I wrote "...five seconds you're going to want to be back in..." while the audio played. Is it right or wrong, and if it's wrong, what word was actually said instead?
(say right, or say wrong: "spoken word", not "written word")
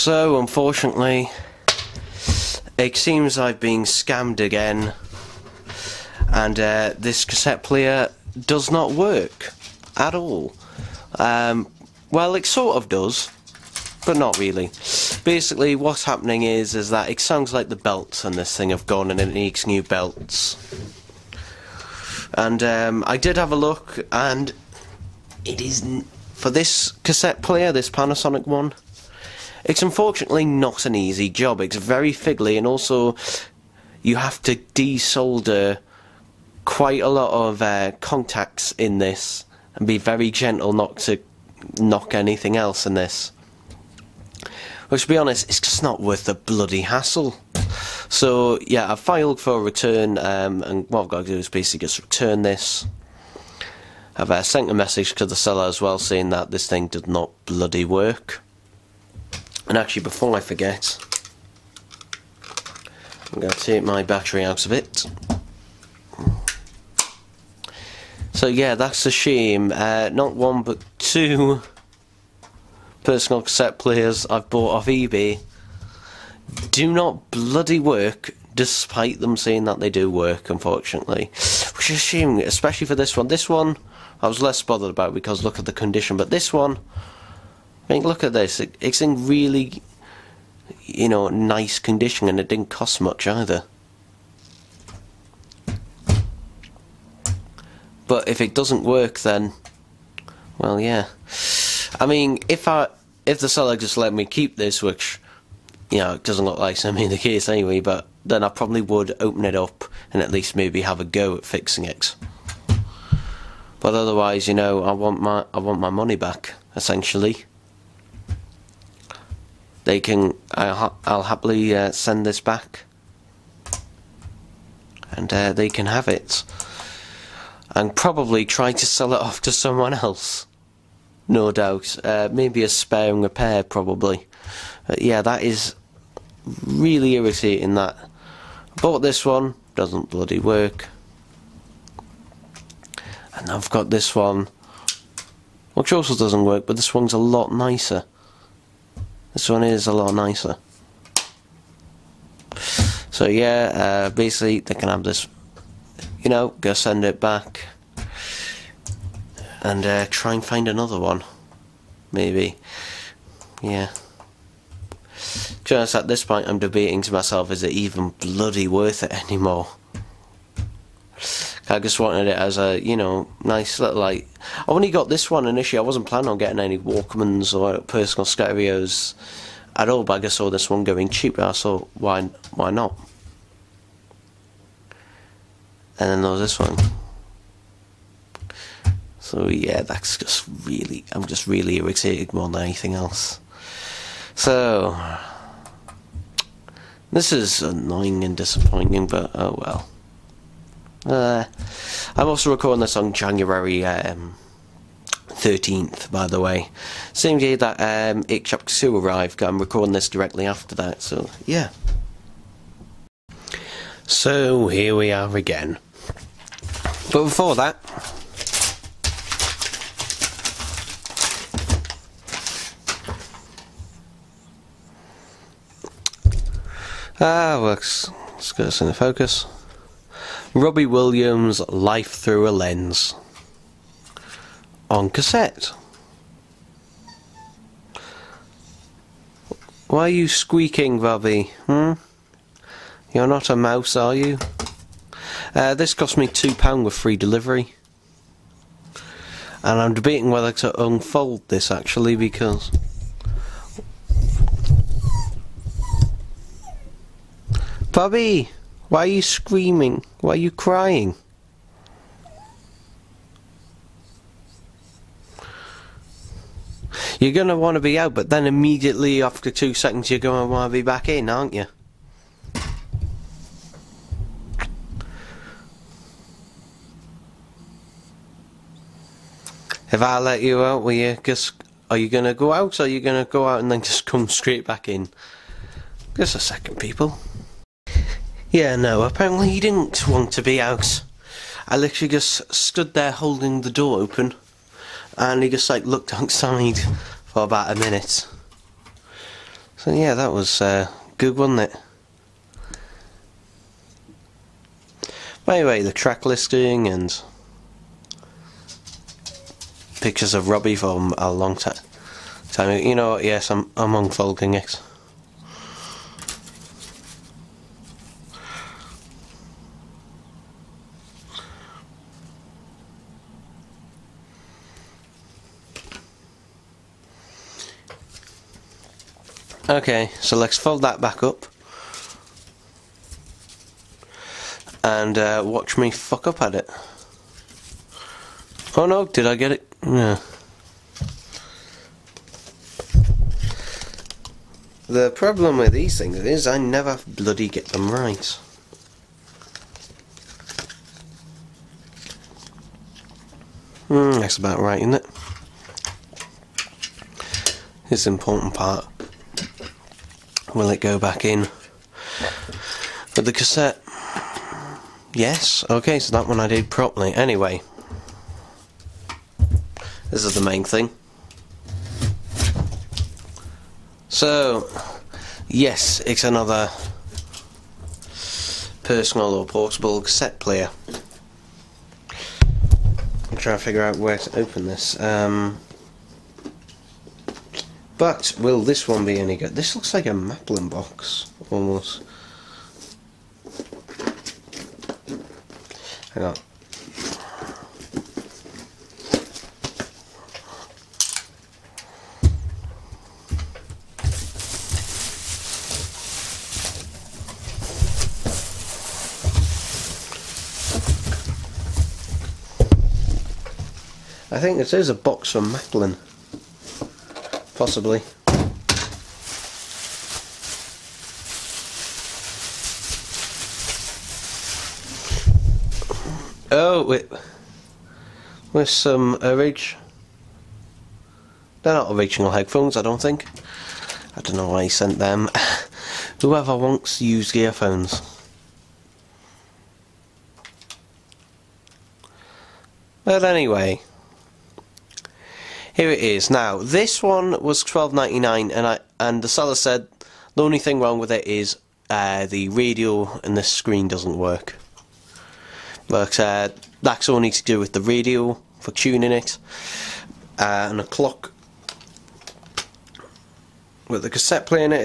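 wrong: "two", not "five".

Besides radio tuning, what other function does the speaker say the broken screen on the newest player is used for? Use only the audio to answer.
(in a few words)
a clock.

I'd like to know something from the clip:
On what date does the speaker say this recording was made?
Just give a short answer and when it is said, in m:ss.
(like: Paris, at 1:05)
January 13th, at 3:23.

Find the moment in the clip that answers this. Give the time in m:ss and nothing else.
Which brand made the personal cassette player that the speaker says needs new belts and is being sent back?
0:27.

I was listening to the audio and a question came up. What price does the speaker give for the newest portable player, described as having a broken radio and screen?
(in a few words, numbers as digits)
12.99.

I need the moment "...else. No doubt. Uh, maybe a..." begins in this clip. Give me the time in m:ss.
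2:09.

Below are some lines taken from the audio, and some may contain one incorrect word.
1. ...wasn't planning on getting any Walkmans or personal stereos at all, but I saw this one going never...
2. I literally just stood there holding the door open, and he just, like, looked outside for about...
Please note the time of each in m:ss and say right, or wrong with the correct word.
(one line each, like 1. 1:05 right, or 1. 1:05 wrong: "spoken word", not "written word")
1. 2:55 wrong: "cheaper", not "never"
2. 4:51 right.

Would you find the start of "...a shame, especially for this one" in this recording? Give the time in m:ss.
1:21.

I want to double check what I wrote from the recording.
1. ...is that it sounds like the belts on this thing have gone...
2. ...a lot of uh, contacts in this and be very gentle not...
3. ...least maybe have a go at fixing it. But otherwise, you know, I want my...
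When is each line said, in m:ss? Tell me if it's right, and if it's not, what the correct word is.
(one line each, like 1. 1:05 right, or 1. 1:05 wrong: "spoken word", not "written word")
1. 0:16 right
2. 0:37 right
3. 1:50 right.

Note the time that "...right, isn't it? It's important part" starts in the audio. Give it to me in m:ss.
5:54.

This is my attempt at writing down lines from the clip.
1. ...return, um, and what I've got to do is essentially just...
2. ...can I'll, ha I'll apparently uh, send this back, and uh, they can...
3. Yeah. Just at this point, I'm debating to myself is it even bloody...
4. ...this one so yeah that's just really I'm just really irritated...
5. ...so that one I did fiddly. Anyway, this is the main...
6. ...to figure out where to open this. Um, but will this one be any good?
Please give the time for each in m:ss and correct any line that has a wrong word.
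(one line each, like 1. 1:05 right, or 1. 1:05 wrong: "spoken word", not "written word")
1. 0:49 wrong: "basically", not "essentially"
2. 2:00 wrong: "happily", not "apparently"
3. 2:43 right
4. 3:06 right
5. 6:05 wrong: "properly", not "fiddly"
6. 6:23 right.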